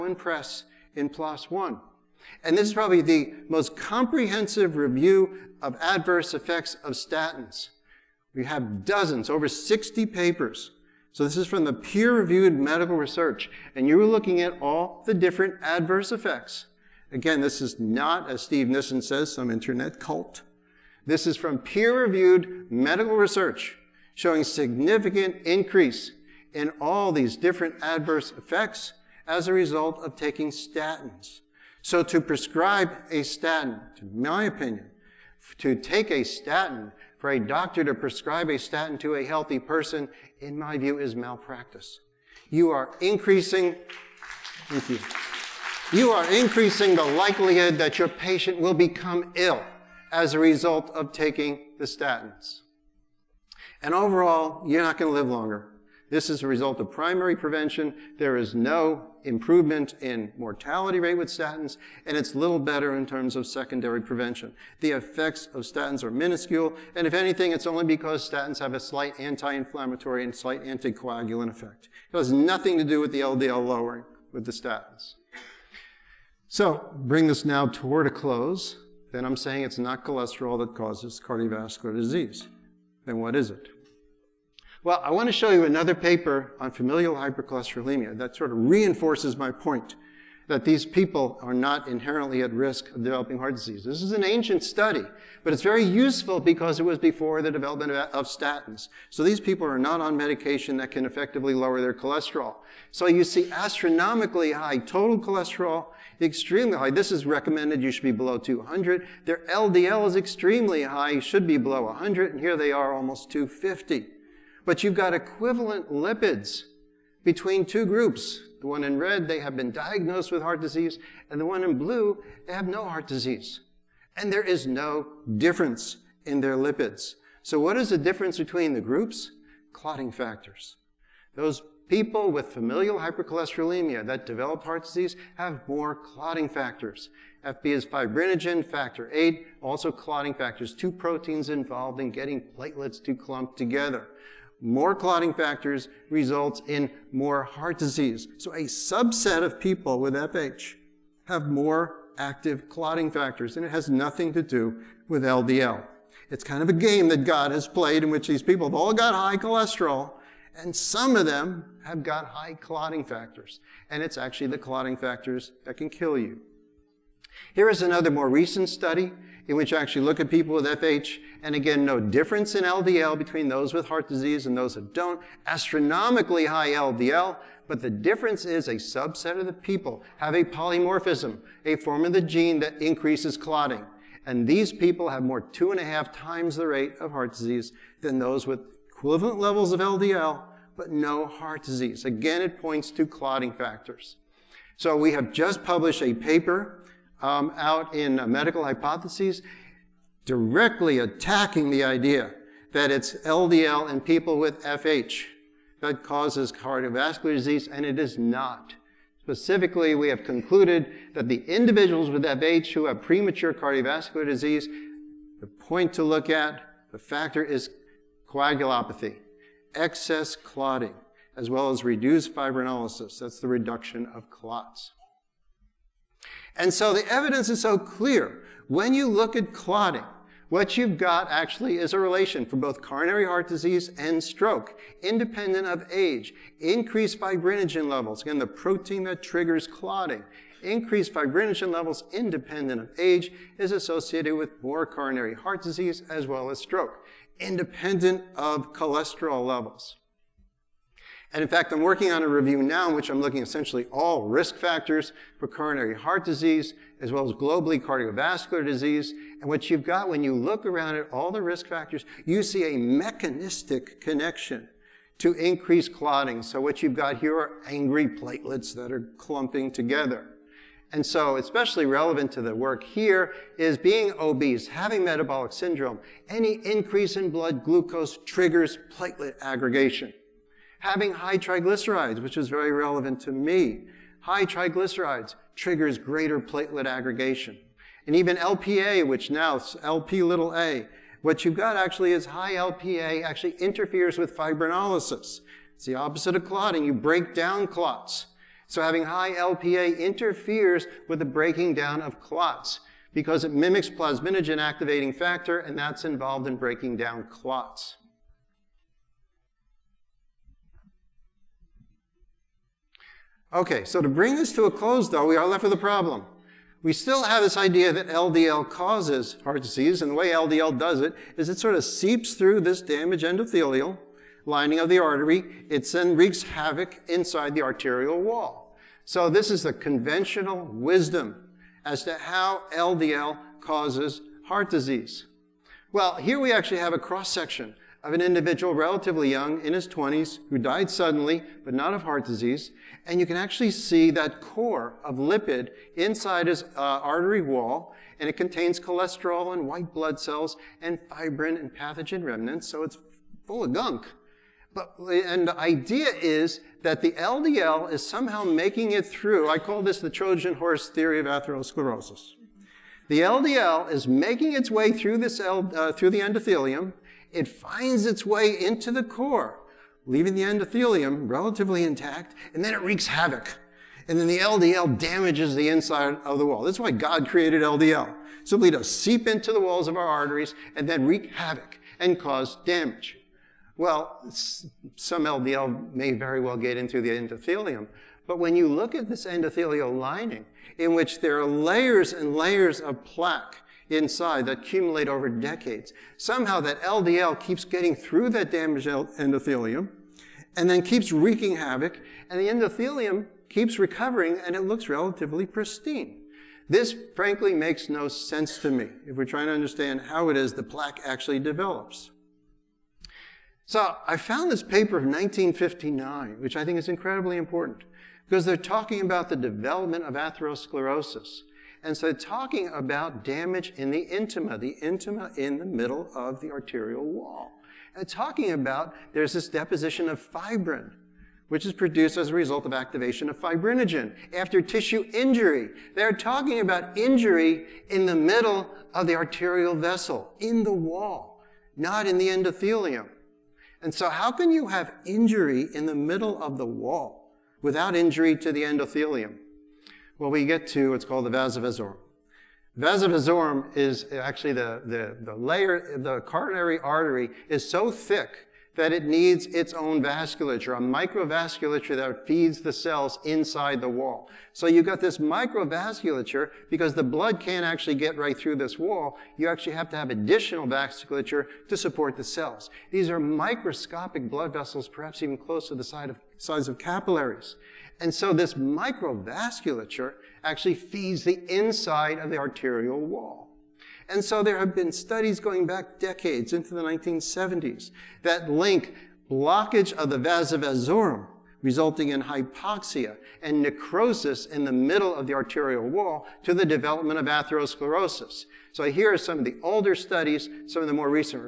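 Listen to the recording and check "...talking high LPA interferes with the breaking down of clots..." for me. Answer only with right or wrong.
wrong.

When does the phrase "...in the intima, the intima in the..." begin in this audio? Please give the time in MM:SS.
07:03.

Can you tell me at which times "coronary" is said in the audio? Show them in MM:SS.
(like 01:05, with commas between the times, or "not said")
03:52, 04:04, 04:15, 07:36.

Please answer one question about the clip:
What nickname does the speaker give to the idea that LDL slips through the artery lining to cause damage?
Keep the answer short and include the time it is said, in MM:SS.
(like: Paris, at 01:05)
Trojan horse theory, at 06:00.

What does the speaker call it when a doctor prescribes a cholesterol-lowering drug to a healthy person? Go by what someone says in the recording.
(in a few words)
malpractice.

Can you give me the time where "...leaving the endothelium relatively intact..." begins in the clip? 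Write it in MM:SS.
06:10.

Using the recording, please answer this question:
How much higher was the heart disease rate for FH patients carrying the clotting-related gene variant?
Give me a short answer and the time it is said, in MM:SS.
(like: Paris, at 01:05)
two and a half times, at 03:05.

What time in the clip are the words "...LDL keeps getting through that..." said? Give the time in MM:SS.
06:36.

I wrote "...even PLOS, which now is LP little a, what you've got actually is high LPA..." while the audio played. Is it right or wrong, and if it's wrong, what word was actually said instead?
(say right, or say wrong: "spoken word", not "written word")
wrong: "LPA", not "PLOS".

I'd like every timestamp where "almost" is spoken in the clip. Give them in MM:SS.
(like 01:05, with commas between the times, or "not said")
01:52.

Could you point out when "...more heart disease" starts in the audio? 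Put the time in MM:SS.
02:27.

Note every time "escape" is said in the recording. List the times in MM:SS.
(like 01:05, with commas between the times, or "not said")
not said.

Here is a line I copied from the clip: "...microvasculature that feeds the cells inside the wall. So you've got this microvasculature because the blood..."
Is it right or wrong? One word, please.
right.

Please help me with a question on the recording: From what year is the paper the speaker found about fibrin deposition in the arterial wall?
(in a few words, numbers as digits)
1959.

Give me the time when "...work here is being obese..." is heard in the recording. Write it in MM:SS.
04:32.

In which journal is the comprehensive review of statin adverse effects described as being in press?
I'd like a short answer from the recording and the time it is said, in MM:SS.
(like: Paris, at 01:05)
PLOS One, at 00:01.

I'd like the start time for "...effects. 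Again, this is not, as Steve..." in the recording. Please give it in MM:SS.
00:16.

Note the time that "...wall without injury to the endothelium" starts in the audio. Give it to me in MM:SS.
07:26.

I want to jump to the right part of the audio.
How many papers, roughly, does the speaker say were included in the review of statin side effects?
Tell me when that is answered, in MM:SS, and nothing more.
00:09.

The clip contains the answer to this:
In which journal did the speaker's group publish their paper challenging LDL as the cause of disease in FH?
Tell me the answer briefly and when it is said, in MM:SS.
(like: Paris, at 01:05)
Medical Hypotheses, at 03:18.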